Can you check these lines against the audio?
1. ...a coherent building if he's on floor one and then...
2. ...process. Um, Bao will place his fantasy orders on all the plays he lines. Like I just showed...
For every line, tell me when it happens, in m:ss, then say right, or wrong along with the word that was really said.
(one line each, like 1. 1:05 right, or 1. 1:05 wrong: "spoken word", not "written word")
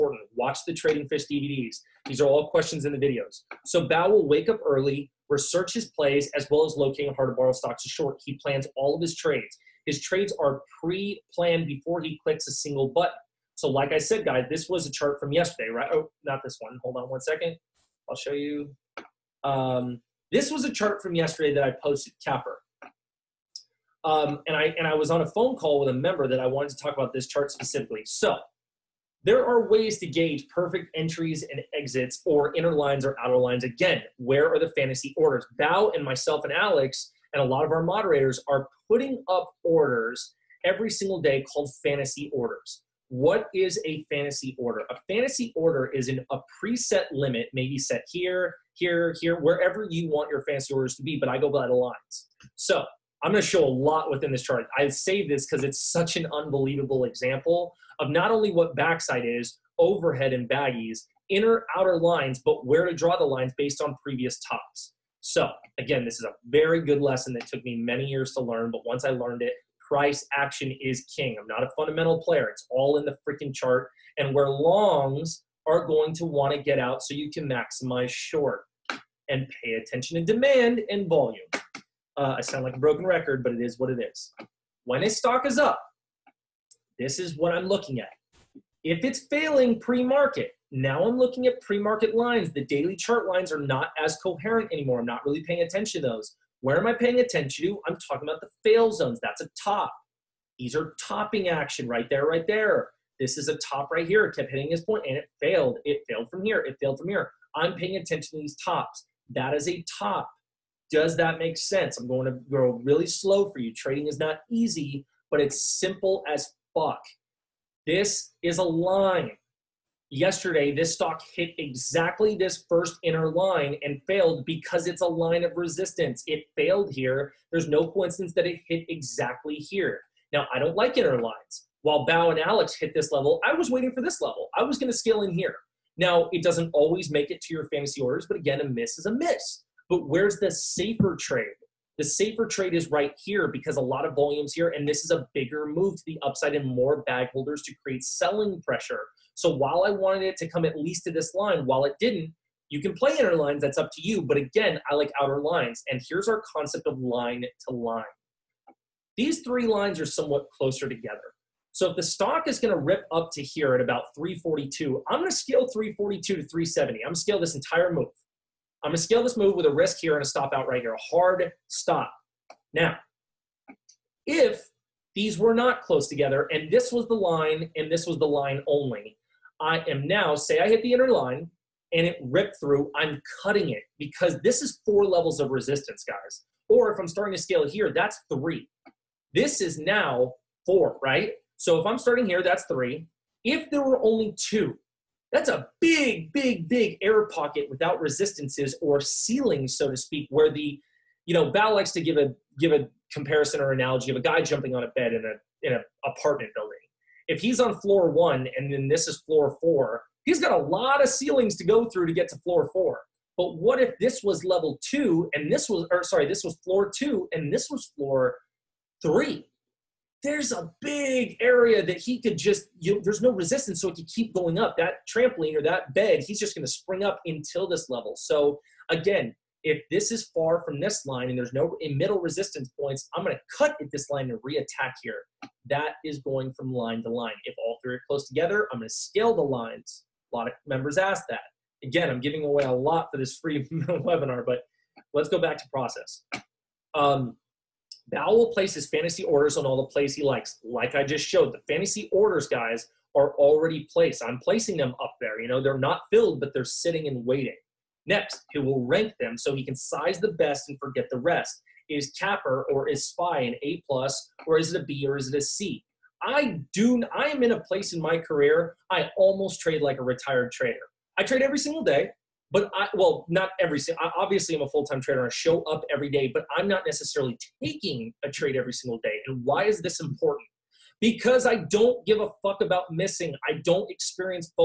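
1. 3:25 wrong: "apartment", not "coherent"
2. 4:05 wrong: "likes", not "lines".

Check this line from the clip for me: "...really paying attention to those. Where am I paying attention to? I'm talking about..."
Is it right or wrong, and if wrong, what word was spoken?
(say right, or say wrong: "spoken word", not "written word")
right.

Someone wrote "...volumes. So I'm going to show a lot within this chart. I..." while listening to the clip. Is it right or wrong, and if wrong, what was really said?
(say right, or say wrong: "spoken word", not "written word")
wrong: "lines", not "volumes".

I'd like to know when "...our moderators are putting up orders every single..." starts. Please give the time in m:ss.
0:37.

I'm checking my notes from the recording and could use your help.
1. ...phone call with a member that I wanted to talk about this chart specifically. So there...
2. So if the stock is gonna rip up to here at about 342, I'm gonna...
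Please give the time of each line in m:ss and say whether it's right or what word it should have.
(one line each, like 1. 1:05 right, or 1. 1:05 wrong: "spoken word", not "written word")
1. 0:25 right
2. 2:41 right.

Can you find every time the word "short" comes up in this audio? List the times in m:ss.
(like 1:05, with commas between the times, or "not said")
0:07, 1:18.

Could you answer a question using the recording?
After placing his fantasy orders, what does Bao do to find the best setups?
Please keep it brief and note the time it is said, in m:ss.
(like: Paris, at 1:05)
rank them, at 4:18.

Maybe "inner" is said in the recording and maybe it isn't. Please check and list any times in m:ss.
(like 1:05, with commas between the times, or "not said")
0:32, 1:01, 2:03, 2:10, 2:33, 3:00.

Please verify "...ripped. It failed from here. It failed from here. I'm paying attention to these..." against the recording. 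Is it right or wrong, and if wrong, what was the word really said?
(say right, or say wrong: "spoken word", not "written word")
wrong: "failed", not "ripped".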